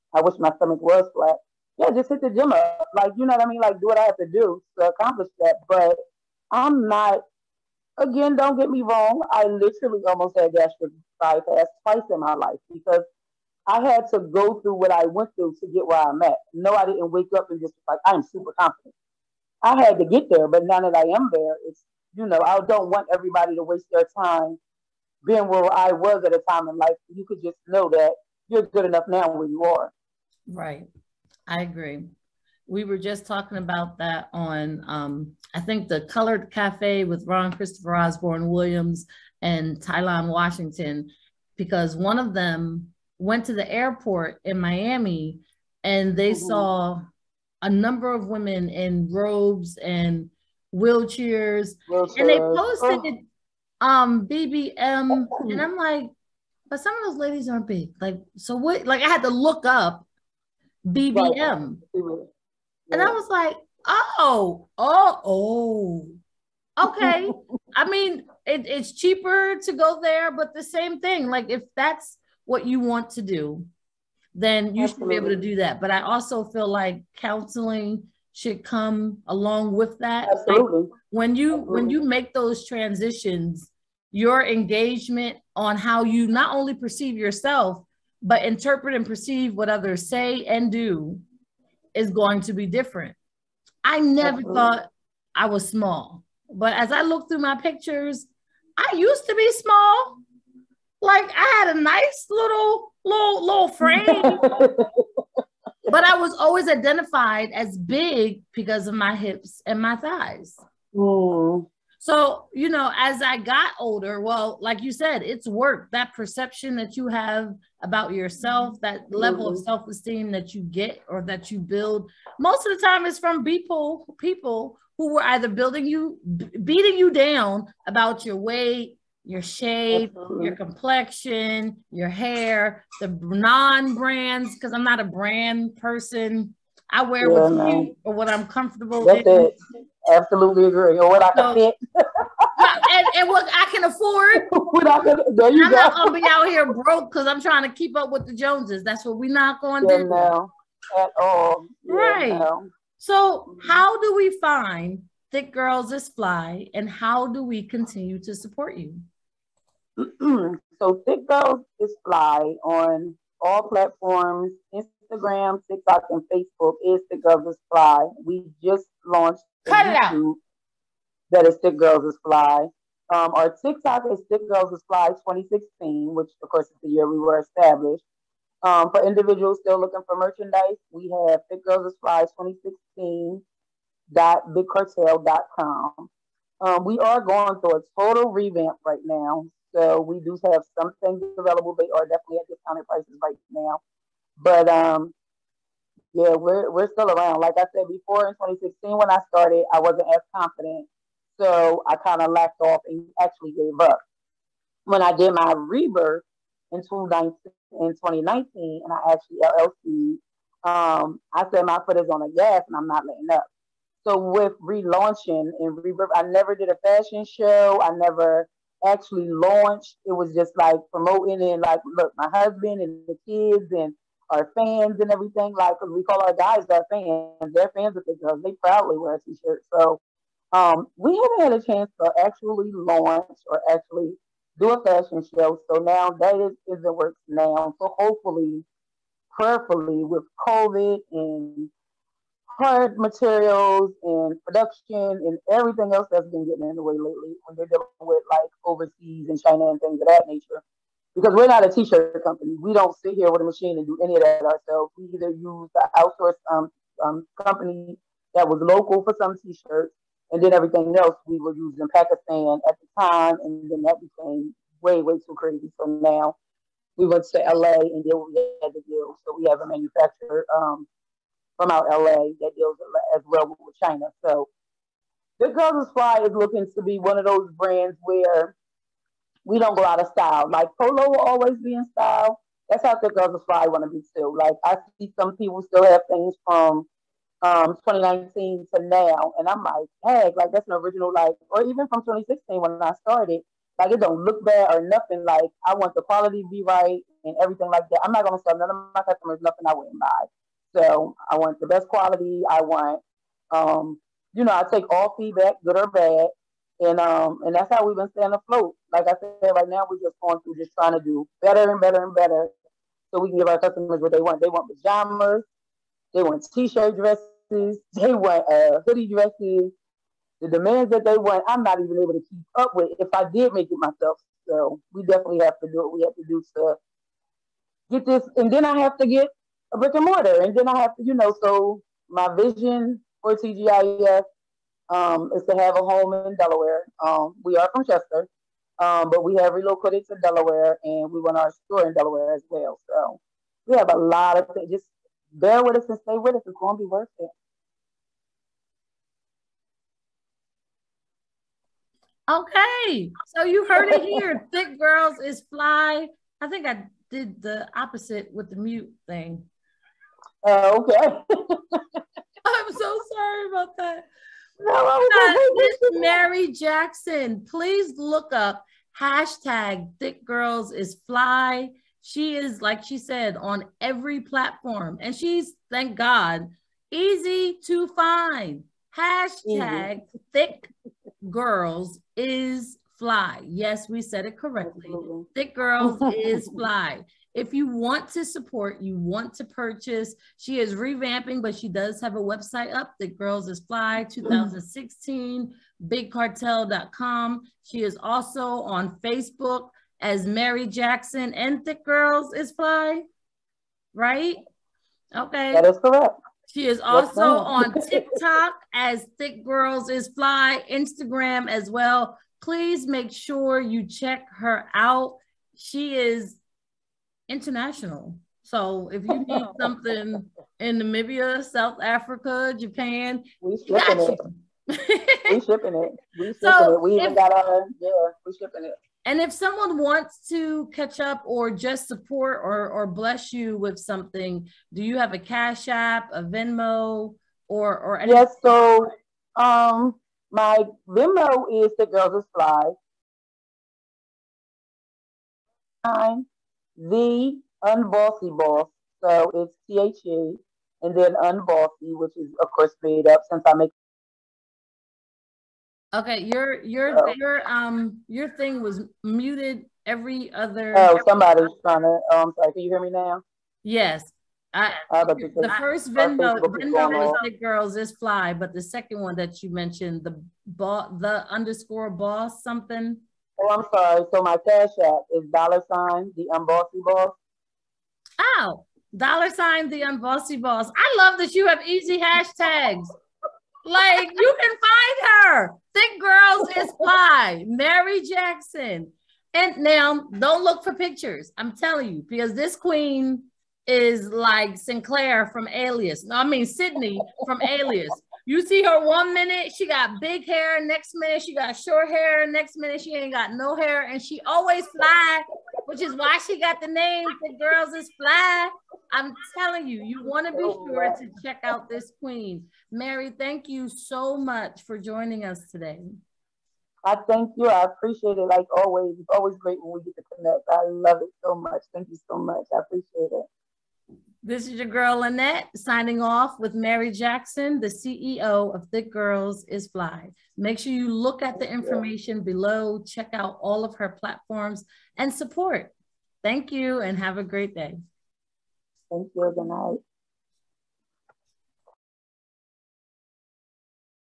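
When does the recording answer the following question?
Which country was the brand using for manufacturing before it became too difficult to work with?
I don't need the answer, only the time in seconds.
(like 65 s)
261 s.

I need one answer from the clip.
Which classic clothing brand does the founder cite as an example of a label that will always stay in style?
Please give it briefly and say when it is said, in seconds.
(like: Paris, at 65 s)
Polo, at 280 s.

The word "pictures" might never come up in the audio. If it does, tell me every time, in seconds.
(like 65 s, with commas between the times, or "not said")
97 s, 490 s.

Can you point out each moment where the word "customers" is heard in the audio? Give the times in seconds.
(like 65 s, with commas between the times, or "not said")
299 s, 313 s.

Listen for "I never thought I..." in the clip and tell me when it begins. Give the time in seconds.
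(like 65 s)
93 s.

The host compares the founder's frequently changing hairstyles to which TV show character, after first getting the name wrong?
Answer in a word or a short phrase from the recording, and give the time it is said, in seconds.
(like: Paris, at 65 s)
Sydney from Alias, at 496 s.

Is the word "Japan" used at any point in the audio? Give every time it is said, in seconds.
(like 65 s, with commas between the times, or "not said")
422 s.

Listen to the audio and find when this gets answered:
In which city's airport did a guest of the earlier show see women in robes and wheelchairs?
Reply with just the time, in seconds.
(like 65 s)
44 s.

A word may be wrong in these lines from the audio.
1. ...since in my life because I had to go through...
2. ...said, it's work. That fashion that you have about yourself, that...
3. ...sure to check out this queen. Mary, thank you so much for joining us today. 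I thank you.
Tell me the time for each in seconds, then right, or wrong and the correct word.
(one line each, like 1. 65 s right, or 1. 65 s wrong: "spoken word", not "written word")
1. 11 s wrong: "twice", not "since"
2. 114 s wrong: "perception", not "fashion"
3. 510 s right.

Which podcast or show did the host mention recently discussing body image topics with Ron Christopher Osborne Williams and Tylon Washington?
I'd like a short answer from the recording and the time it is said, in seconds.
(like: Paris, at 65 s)
The Colored Cafe, at 36 s.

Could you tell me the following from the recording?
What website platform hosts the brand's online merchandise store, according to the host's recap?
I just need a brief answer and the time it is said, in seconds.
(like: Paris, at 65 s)
bigcartel.com, at 395 s.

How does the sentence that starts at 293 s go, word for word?
Like it don't look bad or nothing.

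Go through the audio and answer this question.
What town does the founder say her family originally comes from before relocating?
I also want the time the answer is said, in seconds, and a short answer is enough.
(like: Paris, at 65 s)
Chester, at 337 s.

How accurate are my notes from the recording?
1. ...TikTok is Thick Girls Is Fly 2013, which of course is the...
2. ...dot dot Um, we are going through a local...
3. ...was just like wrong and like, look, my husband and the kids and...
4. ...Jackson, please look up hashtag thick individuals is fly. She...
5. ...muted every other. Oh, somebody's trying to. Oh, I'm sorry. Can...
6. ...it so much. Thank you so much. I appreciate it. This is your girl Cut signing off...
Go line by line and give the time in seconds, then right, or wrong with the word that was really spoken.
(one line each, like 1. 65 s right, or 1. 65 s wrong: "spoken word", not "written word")
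1. 173 s wrong: "2016", not "2013"
2. 184 s wrong: "total", not "local"
3. 220 s wrong: "promoting", not "wrong"
4. 366 s wrong: "girls", not "individuals"
5. 459 s right
6. 521 s wrong: "Annette", not "Cut".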